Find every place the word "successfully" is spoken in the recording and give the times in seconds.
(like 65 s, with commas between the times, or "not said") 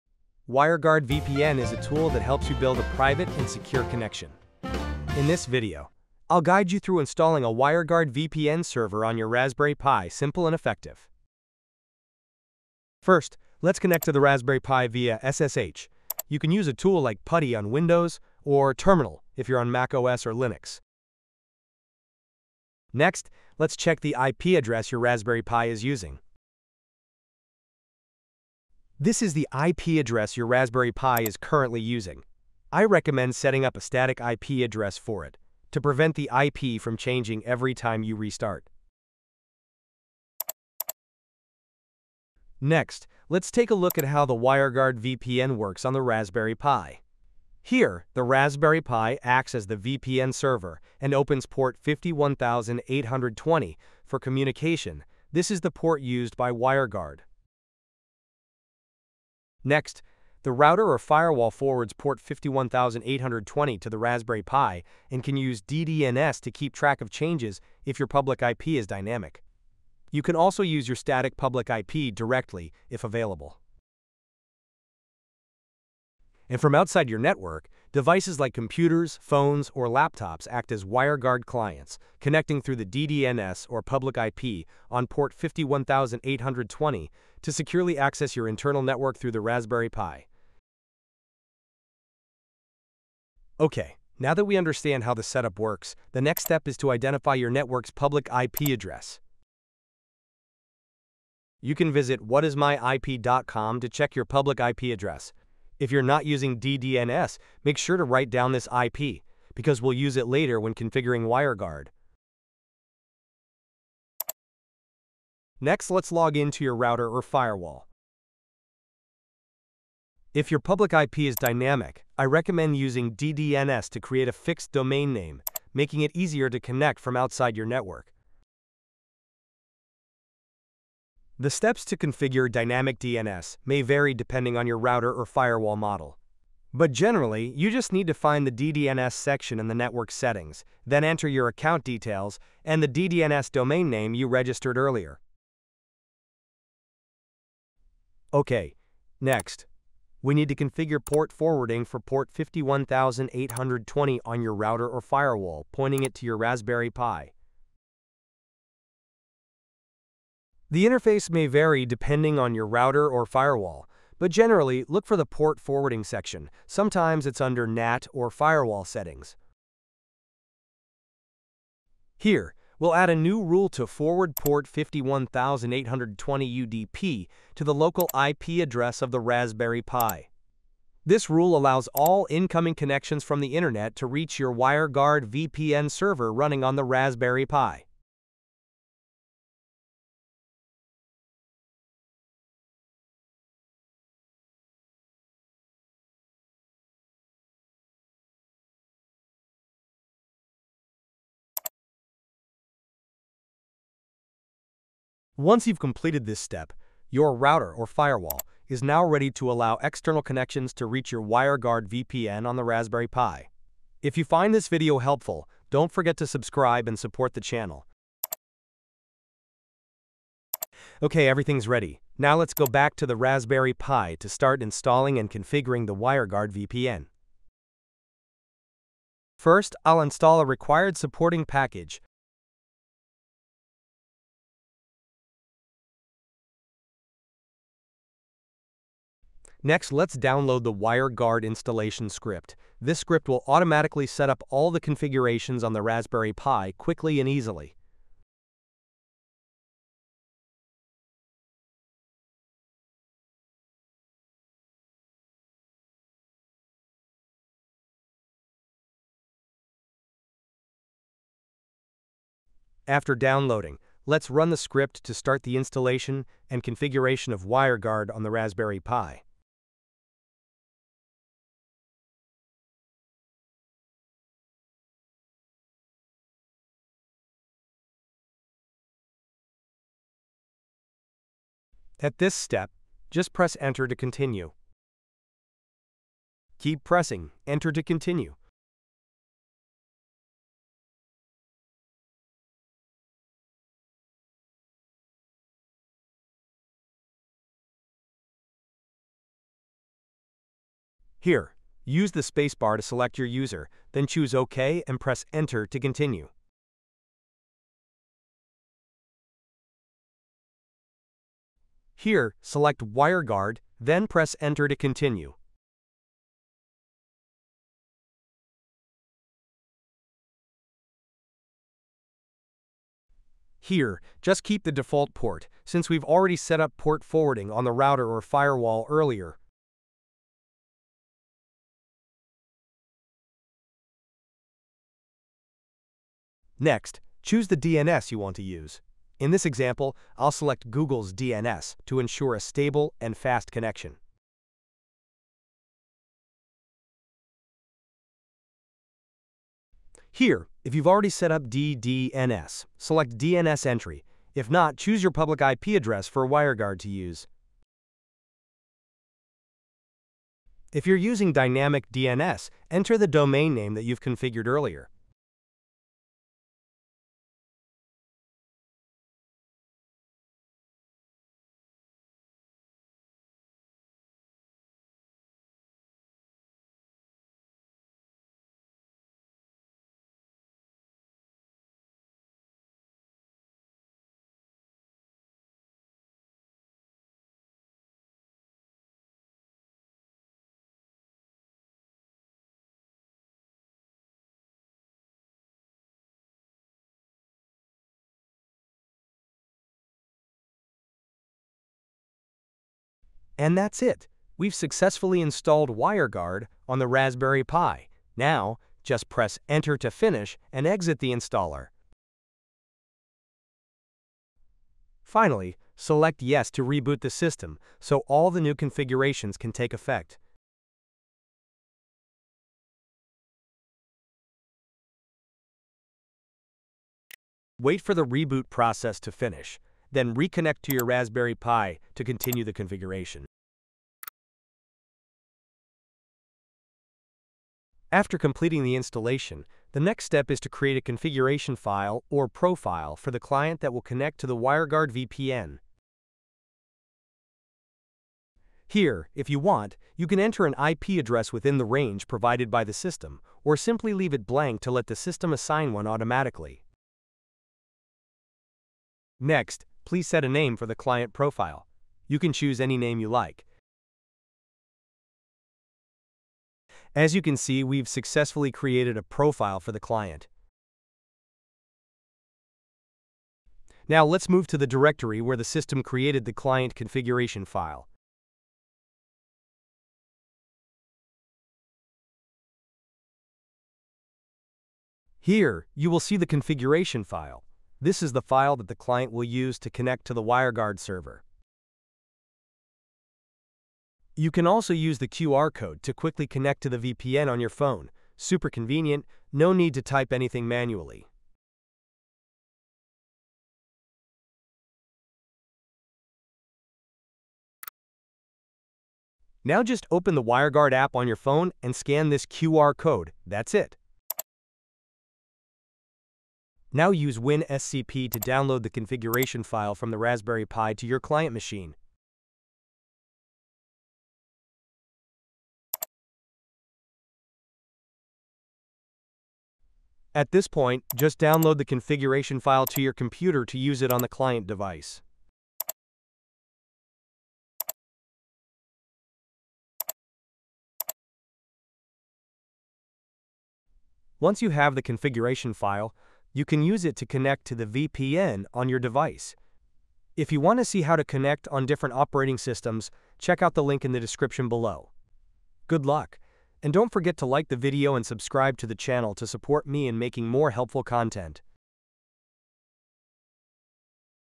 404 s, 467 s.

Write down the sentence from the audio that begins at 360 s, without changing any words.
If you're using Dynamic DNS, enter the domain name that you've configured earlier.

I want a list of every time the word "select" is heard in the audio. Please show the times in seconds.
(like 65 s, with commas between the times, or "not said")
302 s, 312 s, 340 s, 352 s, 415 s.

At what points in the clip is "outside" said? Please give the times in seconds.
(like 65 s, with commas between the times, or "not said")
76 s, 127 s.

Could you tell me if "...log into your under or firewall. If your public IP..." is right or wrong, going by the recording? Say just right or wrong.
wrong.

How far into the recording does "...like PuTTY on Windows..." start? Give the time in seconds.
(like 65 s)
17 s.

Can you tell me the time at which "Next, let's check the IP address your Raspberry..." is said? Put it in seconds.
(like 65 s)
22 s.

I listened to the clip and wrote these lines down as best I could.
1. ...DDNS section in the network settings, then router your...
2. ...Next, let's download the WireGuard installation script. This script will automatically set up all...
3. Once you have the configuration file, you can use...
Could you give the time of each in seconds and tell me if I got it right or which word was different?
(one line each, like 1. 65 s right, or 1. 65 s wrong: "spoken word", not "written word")
1. 138 s wrong: "enter", not "router"
2. 239 s right
3. 544 s right.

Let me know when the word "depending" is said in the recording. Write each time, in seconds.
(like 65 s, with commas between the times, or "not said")
134 s, 161 s.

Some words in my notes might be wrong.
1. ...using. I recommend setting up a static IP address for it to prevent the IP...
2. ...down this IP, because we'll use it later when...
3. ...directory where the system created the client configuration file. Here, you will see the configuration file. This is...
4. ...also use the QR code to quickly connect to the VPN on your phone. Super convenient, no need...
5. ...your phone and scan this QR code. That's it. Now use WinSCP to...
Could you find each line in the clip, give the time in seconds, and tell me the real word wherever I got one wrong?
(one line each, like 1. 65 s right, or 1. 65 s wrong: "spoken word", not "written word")
1. 31 s right
2. 108 s right
3. 474 s right
4. 494 s right
5. 511 s right.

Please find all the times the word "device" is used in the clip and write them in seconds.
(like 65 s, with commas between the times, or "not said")
77 s, 534 s, 548 s.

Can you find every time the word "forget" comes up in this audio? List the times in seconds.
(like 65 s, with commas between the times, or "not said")
215 s, 556 s.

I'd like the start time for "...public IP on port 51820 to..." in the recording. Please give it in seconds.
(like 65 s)
83 s.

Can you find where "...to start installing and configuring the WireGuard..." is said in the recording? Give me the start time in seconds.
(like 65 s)
224 s.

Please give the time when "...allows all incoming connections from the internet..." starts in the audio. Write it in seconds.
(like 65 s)
181 s.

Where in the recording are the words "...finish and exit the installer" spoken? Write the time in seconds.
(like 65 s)
409 s.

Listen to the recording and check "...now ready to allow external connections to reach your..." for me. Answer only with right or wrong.
right.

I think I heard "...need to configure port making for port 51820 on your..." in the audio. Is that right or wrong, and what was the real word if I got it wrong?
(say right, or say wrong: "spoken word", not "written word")
wrong: "forwarding", not "making".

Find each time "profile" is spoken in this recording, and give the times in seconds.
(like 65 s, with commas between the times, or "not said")
442 s, 461 s, 469 s.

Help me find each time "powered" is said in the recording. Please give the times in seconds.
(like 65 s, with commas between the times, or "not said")
not said.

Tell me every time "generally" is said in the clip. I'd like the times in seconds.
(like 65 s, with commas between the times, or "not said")
136 s, 164 s.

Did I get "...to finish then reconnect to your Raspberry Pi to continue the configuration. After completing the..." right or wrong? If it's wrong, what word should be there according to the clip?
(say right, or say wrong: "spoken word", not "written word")
right.